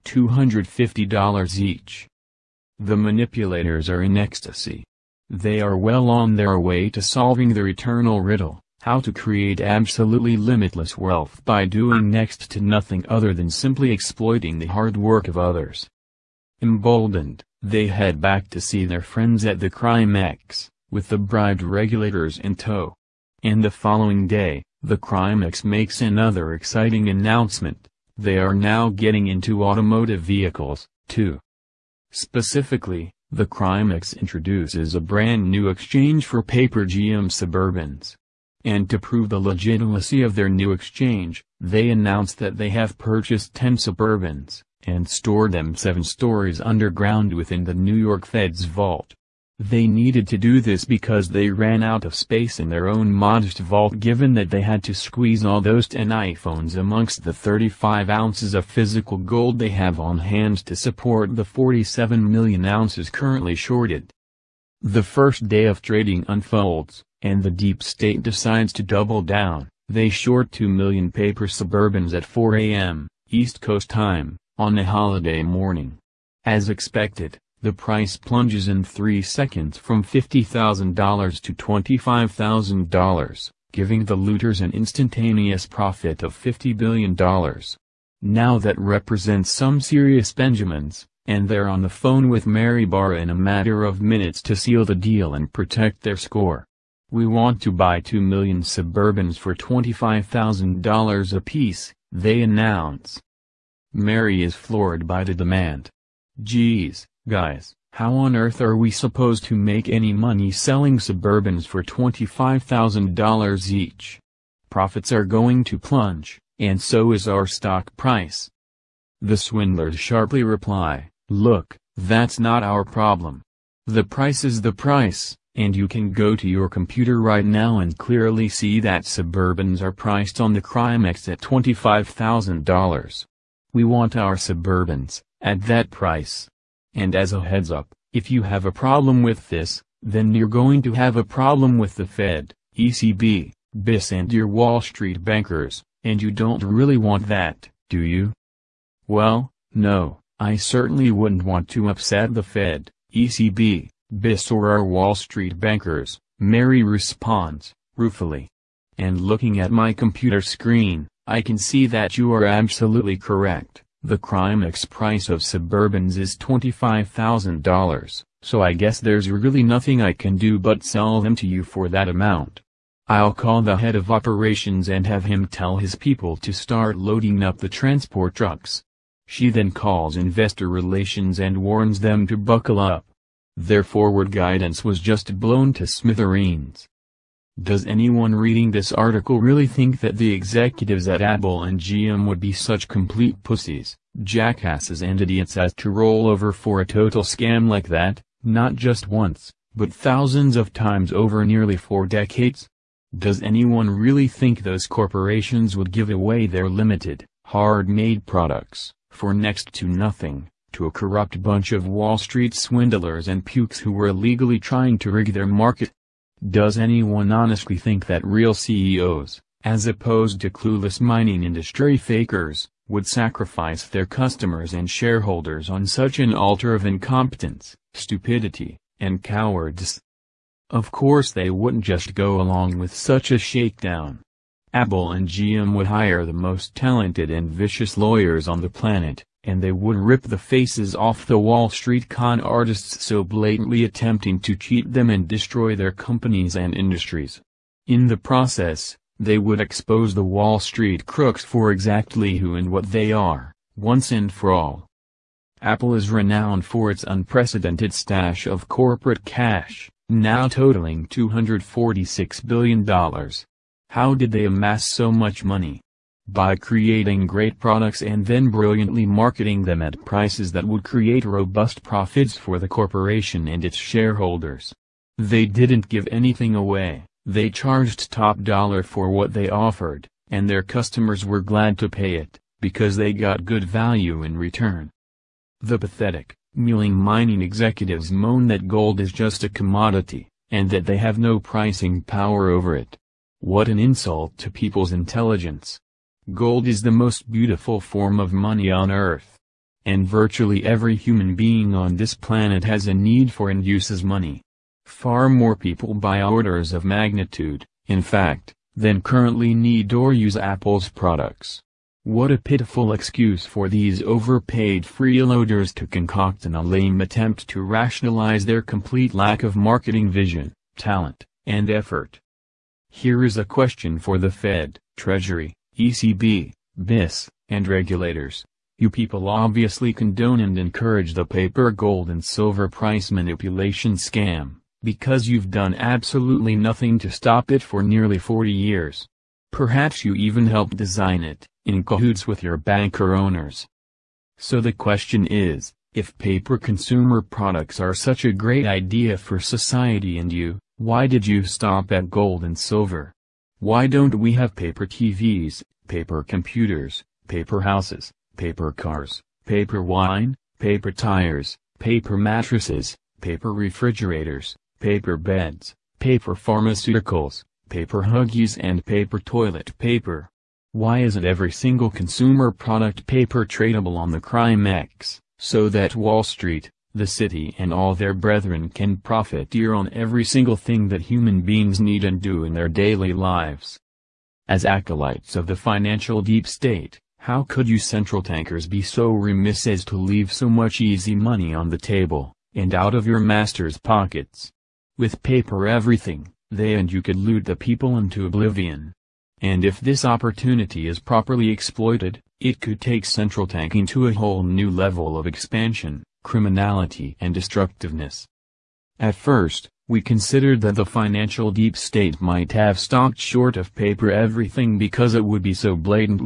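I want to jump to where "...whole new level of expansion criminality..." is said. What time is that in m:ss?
6:44.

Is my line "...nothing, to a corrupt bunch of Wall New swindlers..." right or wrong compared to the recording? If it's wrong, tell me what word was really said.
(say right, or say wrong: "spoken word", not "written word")
wrong: "Street", not "New".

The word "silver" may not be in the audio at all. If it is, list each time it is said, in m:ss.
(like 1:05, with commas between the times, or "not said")
5:32, 5:52.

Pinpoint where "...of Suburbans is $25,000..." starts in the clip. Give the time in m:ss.
2:45.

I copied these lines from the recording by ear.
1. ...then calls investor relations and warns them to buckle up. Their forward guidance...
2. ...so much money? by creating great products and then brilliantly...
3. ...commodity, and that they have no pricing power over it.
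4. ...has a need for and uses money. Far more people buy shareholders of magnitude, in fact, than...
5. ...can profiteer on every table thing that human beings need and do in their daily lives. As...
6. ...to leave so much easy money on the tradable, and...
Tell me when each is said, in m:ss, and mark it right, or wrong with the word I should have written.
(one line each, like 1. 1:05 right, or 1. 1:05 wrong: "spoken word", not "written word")
1. 2:59 right
2. 4:24 right
3. 4:49 right
4. 5:02 wrong: "orders", not "shareholders"
5. 6:18 wrong: "single", not "table"
6. 6:29 wrong: "table", not "tradable".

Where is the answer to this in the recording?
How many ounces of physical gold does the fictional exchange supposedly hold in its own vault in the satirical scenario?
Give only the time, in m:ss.
0:57.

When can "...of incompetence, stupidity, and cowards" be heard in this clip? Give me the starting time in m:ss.
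3:46.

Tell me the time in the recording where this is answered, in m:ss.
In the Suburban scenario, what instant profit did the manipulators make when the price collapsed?
1:26.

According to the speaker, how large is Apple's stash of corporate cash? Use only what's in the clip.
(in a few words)
$246 billion.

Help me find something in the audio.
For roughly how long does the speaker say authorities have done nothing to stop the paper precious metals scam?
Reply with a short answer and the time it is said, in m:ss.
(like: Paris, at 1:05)
nearly 40 years, at 5:37.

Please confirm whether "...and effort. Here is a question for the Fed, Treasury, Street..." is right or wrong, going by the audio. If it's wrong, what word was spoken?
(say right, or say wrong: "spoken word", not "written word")
wrong: "ECB", not "Street".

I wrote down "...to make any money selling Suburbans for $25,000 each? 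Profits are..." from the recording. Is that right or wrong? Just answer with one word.
right.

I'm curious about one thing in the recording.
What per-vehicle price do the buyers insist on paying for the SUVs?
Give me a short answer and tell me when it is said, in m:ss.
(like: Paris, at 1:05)
$25,000, at 1:39.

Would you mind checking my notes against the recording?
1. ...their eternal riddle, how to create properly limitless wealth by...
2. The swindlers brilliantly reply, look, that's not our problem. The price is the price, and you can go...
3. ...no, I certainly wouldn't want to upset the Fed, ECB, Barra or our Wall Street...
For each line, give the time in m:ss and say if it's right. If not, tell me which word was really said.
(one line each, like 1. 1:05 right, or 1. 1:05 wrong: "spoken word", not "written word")
1. 0:07 wrong: "absolutely", not "properly"
2. 1:59 wrong: "sharply", not "brilliantly"
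3. 2:29 wrong: "BIS", not "Barra".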